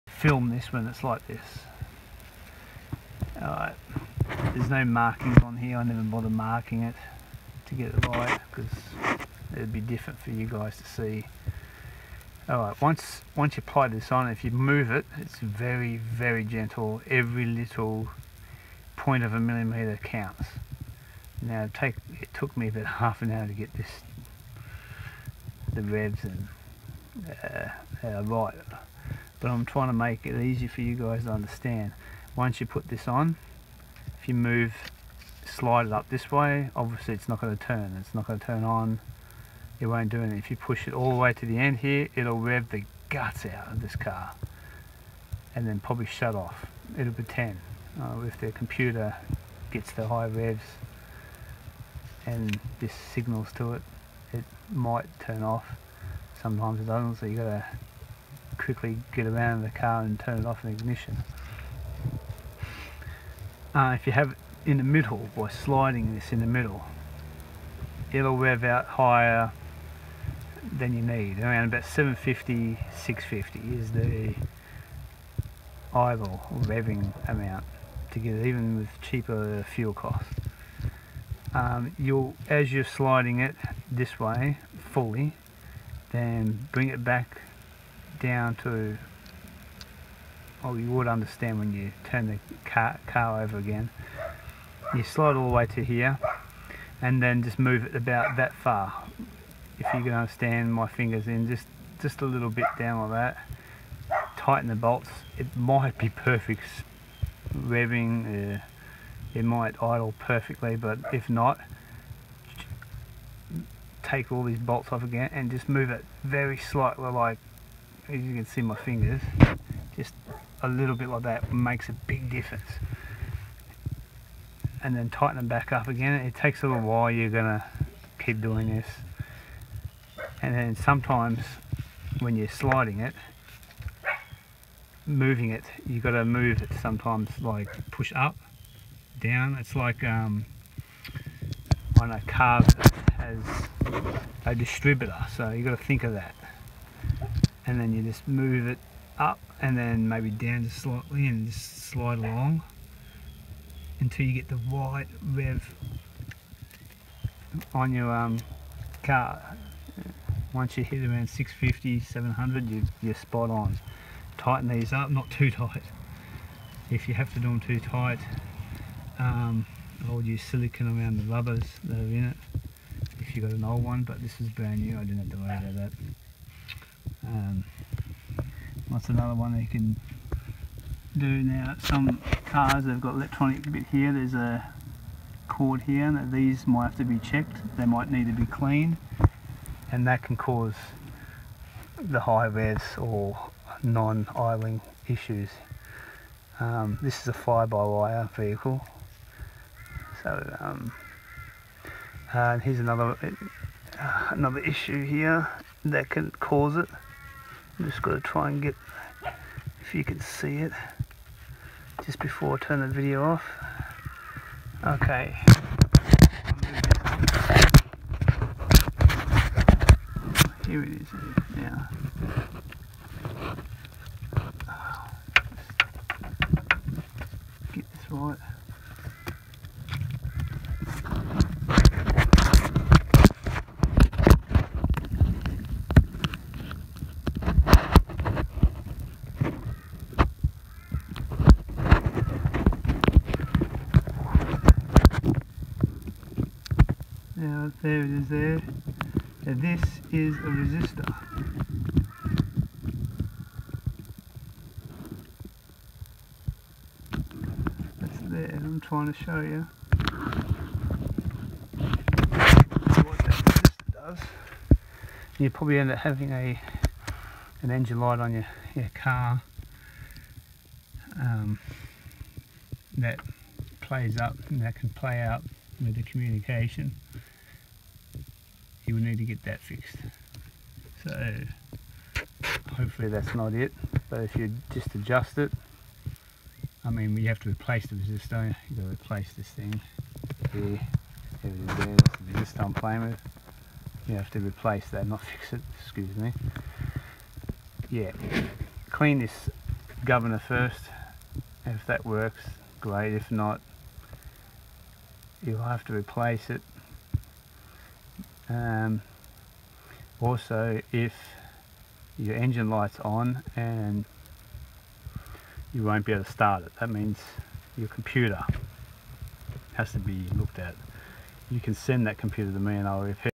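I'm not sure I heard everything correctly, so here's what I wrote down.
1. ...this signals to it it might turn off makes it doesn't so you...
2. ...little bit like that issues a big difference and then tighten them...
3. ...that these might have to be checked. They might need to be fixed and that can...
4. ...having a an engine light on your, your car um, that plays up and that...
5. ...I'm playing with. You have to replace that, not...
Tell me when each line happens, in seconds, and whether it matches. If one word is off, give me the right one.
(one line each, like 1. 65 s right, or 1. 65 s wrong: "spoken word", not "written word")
1. 52 s wrong: "sometimes", not "makes"
2. 120 s wrong: "makes", not "issues"
3. 186 s wrong: "cleaned", not "fixed"
4. 265 s right
5. 292 s right.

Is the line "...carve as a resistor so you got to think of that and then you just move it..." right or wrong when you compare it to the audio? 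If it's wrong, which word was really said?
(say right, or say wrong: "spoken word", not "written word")
wrong: "distributor", not "resistor".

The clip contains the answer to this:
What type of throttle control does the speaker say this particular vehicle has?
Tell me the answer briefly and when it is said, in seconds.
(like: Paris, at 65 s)
fly-by-wire, at 197 s.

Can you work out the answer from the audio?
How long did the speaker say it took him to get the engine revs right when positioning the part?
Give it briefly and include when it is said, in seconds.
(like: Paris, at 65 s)
half an hour, at 22 s.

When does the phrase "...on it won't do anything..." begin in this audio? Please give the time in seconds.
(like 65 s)
38 s.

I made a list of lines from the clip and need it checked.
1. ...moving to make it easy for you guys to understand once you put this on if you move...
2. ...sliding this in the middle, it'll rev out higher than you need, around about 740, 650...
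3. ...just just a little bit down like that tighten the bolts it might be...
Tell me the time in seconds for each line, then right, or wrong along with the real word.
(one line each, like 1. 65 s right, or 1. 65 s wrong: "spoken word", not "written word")
1. 29 s wrong: "trying", not "moving"
2. 65 s wrong: "750", not "740"
3. 101 s right.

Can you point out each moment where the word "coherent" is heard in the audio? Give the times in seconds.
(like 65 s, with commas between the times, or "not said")
not said.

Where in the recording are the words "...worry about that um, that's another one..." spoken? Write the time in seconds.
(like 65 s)
175 s.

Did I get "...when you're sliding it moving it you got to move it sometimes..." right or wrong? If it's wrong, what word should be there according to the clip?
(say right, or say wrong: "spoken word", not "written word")
right.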